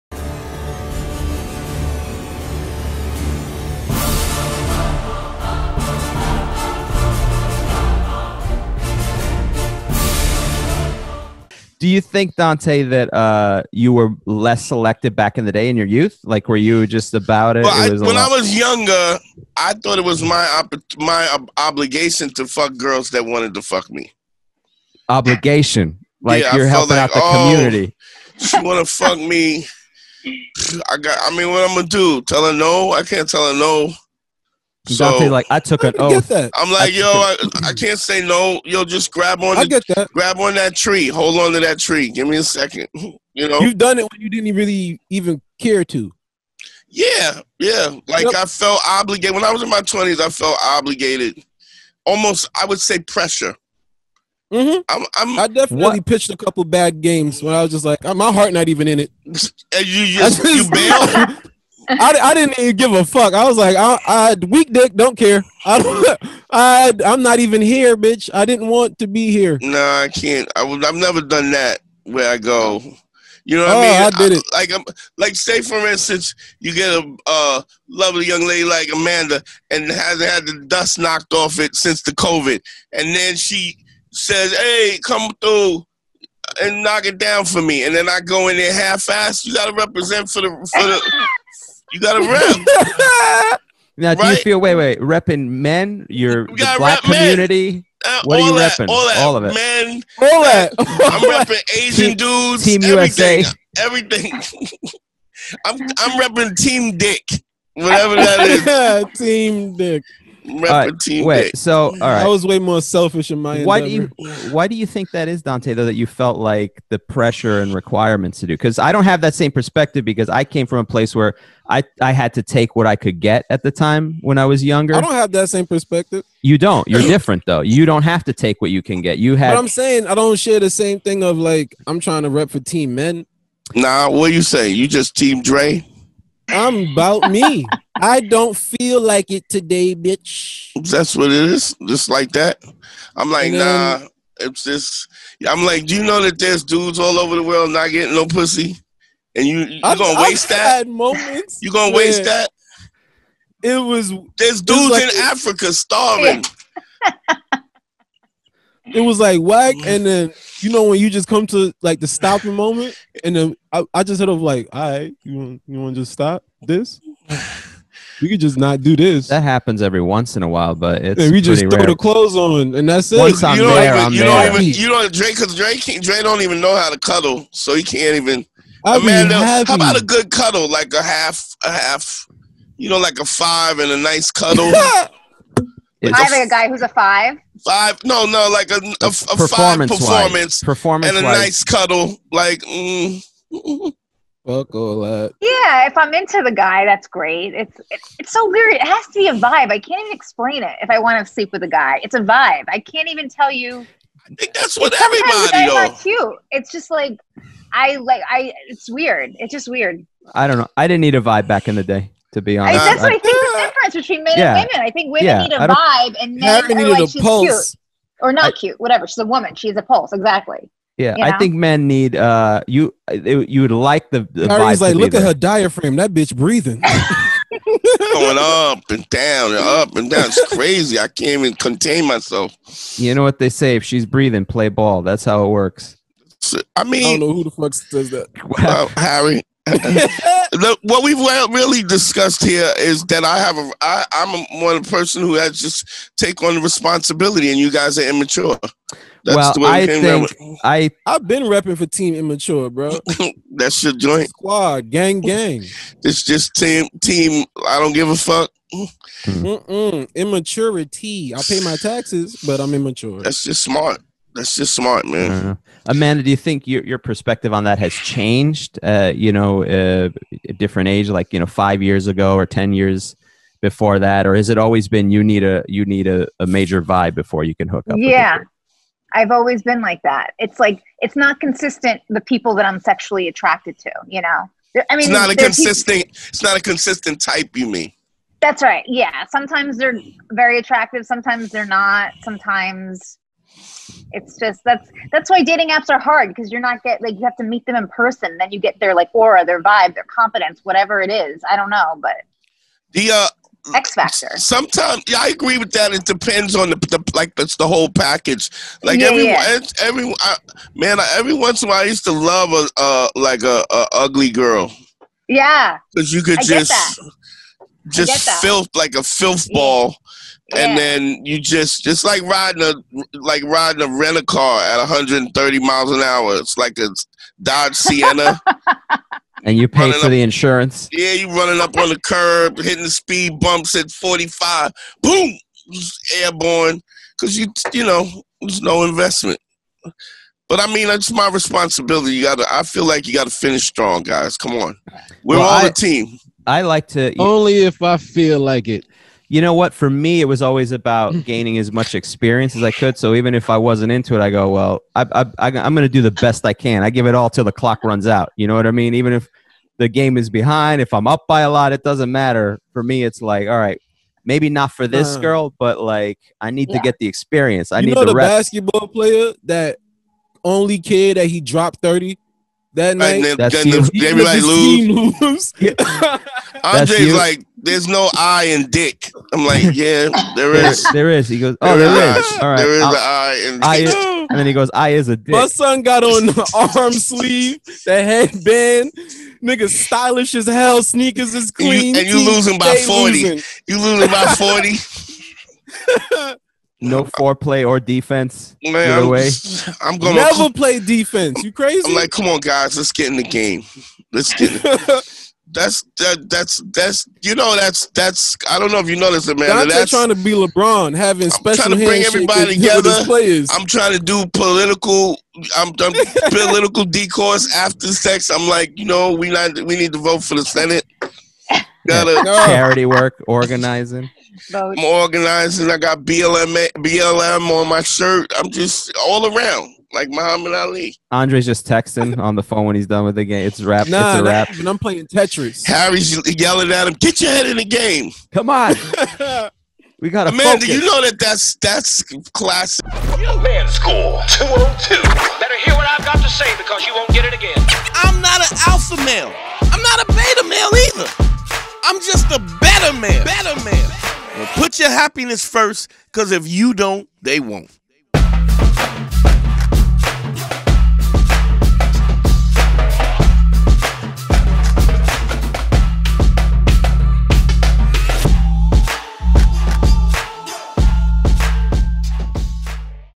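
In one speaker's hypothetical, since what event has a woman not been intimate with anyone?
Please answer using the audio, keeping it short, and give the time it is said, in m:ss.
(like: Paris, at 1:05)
COVID, at 1:22.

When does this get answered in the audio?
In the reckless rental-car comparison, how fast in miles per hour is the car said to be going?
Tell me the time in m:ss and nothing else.
5:24.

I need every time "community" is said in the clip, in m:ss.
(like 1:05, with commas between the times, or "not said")
0:27, 1:37.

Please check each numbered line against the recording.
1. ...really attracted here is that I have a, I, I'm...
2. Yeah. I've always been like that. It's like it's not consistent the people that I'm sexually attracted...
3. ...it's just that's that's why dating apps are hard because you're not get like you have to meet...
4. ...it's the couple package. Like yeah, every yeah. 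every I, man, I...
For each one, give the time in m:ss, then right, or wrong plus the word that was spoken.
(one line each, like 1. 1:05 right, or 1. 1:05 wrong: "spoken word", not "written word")
1. 4:01 wrong: "discussed", not "attracted"
2. 4:37 right
3. 4:54 right
4. 5:07 wrong: "whole", not "couple".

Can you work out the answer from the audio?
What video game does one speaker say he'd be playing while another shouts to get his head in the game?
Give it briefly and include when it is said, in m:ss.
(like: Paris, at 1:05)
Tetris, at 7:15.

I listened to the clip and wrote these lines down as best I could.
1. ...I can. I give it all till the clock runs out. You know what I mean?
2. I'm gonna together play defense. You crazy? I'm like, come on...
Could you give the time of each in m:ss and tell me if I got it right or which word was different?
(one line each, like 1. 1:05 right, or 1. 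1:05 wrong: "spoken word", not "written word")
1. 5:56 right
2. 6:39 wrong: "never", not "together".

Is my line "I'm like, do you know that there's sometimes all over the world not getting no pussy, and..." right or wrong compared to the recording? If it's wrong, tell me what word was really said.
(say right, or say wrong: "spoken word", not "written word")
wrong: "dudes", not "sometimes".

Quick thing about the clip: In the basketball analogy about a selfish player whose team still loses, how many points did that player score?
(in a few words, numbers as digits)
30.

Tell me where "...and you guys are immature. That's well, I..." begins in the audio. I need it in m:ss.
4:07.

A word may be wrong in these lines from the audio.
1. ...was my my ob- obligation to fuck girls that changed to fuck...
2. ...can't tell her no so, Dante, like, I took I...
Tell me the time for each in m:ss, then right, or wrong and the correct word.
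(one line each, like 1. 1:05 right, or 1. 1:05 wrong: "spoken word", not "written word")
1. 0:20 wrong: "wanted", not "changed"
2. 0:33 right.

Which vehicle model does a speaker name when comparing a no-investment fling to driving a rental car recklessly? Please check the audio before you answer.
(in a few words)
Dodge Sienna.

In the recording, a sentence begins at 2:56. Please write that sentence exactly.
Drake don't even know how to cuddle, so he can't even.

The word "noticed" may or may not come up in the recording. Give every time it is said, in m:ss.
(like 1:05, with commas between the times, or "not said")
6:48.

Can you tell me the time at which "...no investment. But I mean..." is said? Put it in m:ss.
5:38.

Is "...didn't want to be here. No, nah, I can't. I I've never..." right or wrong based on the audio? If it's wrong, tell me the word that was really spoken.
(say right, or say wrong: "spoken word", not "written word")
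right.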